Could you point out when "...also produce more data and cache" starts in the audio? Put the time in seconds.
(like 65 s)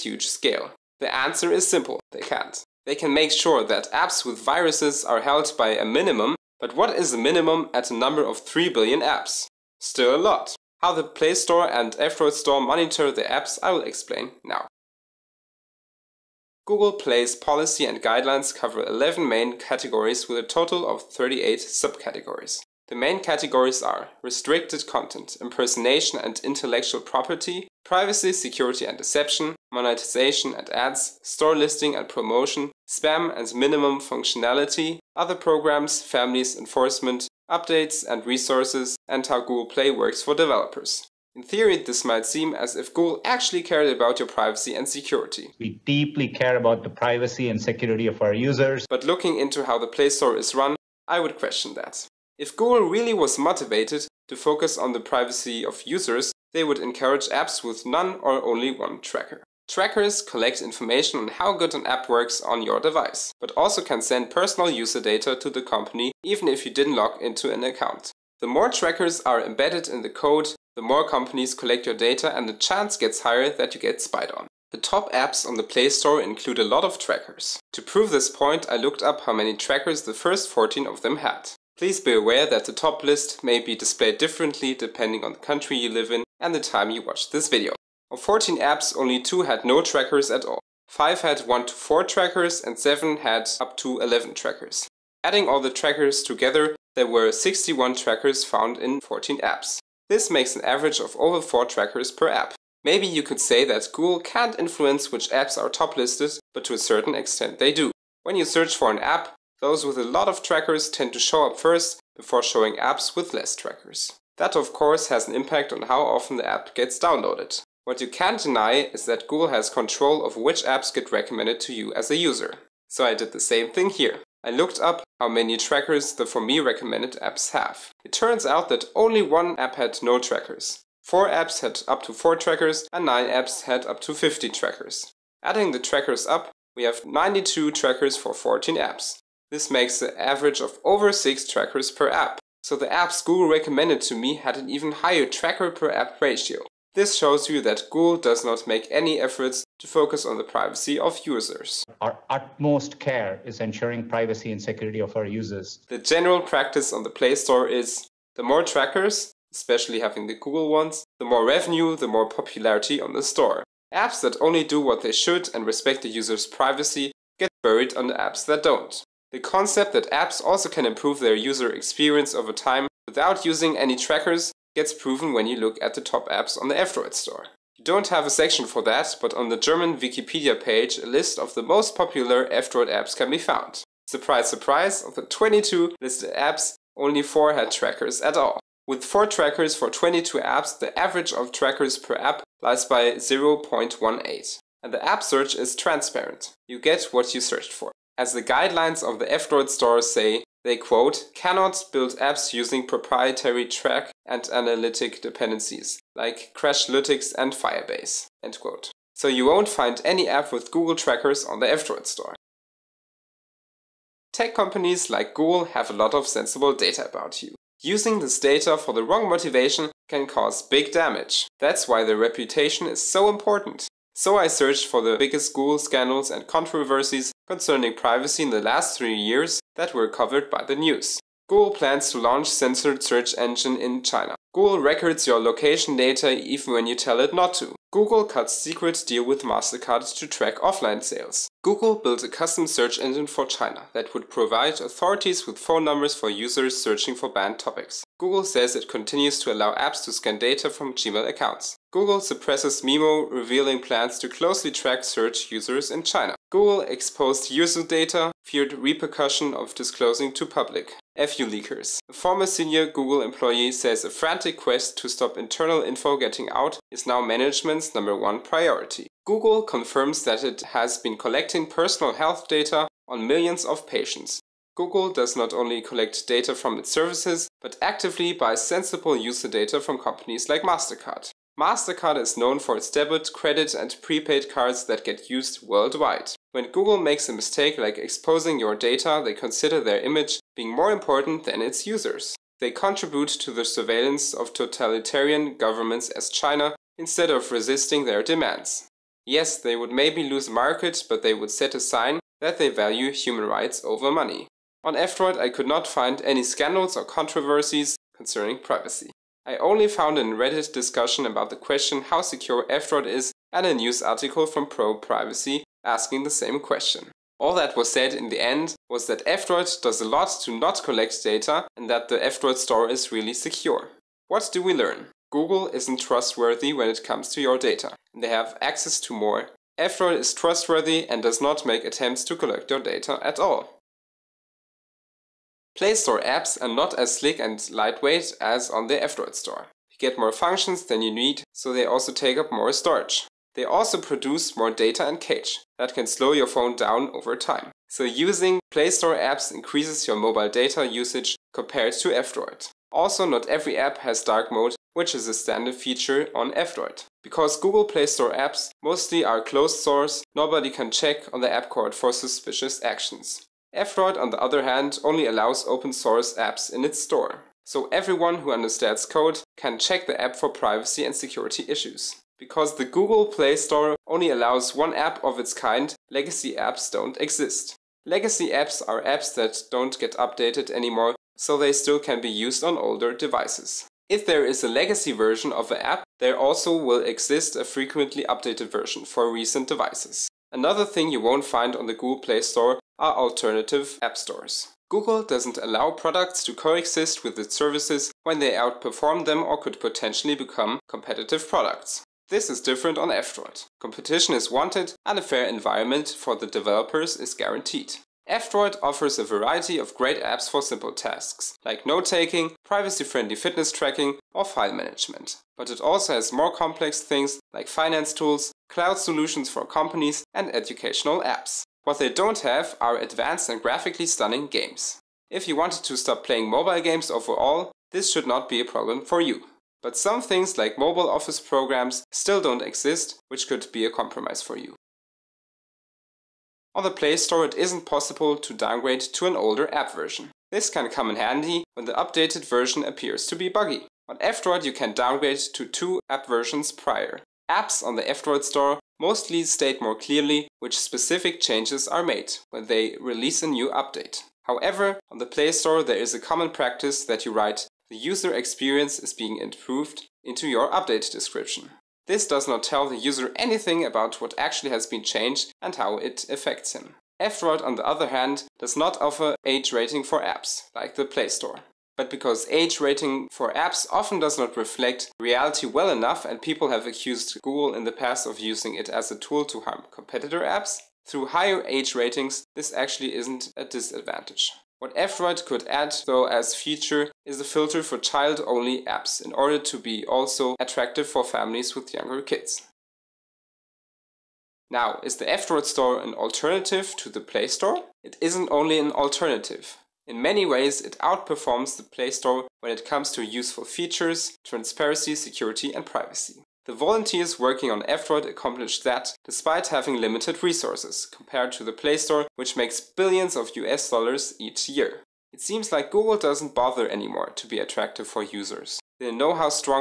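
343 s.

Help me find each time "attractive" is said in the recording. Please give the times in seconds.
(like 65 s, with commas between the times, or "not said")
490 s, 517 s.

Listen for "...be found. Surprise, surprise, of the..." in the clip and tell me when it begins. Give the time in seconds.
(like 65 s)
183 s.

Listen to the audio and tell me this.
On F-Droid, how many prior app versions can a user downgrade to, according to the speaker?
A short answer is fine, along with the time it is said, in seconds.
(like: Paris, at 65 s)
2, at 445 s.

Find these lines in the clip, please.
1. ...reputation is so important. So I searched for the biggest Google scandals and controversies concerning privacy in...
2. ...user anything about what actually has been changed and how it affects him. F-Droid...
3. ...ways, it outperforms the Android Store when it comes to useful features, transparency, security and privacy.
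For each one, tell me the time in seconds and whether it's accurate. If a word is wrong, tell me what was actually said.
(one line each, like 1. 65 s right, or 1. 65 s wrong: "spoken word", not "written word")
1. 222 s right
2. 462 s right
3. 500 s wrong: "Play", not "Android".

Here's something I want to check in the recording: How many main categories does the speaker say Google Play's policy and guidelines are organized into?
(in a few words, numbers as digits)
11.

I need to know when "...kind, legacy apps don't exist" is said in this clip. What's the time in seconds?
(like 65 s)
375 s.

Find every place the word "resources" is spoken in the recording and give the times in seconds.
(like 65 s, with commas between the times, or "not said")
38 s, 510 s.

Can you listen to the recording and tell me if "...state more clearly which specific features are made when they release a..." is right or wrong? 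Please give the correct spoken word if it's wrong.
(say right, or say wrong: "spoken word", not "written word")
wrong: "changes", not "features".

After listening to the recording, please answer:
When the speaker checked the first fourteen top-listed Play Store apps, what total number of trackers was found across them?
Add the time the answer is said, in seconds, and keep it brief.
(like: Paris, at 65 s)
61, at 97 s.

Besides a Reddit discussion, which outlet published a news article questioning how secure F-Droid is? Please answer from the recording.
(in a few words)
Pro Privacy.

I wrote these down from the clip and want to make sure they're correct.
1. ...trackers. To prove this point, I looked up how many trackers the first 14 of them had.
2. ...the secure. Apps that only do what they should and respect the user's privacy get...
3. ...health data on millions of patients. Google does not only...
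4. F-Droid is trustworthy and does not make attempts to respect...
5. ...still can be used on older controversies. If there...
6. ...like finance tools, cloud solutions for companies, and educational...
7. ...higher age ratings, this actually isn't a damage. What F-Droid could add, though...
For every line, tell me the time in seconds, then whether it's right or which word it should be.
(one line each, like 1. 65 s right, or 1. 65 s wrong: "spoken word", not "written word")
1. 76 s right
2. 163 s wrong: "store", not "secure"
3. 272 s right
4. 329 s wrong: "collect", not "respect"
5. 381 s wrong: "devices", not "controversies"
6. 417 s right
7. 481 s wrong: "disadvantage", not "damage".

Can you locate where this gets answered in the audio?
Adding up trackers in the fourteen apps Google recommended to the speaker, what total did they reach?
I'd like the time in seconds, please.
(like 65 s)
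137 s.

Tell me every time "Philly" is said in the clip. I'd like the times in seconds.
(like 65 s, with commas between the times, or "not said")
not said.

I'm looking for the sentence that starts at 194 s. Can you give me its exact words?
And the app search is transparent.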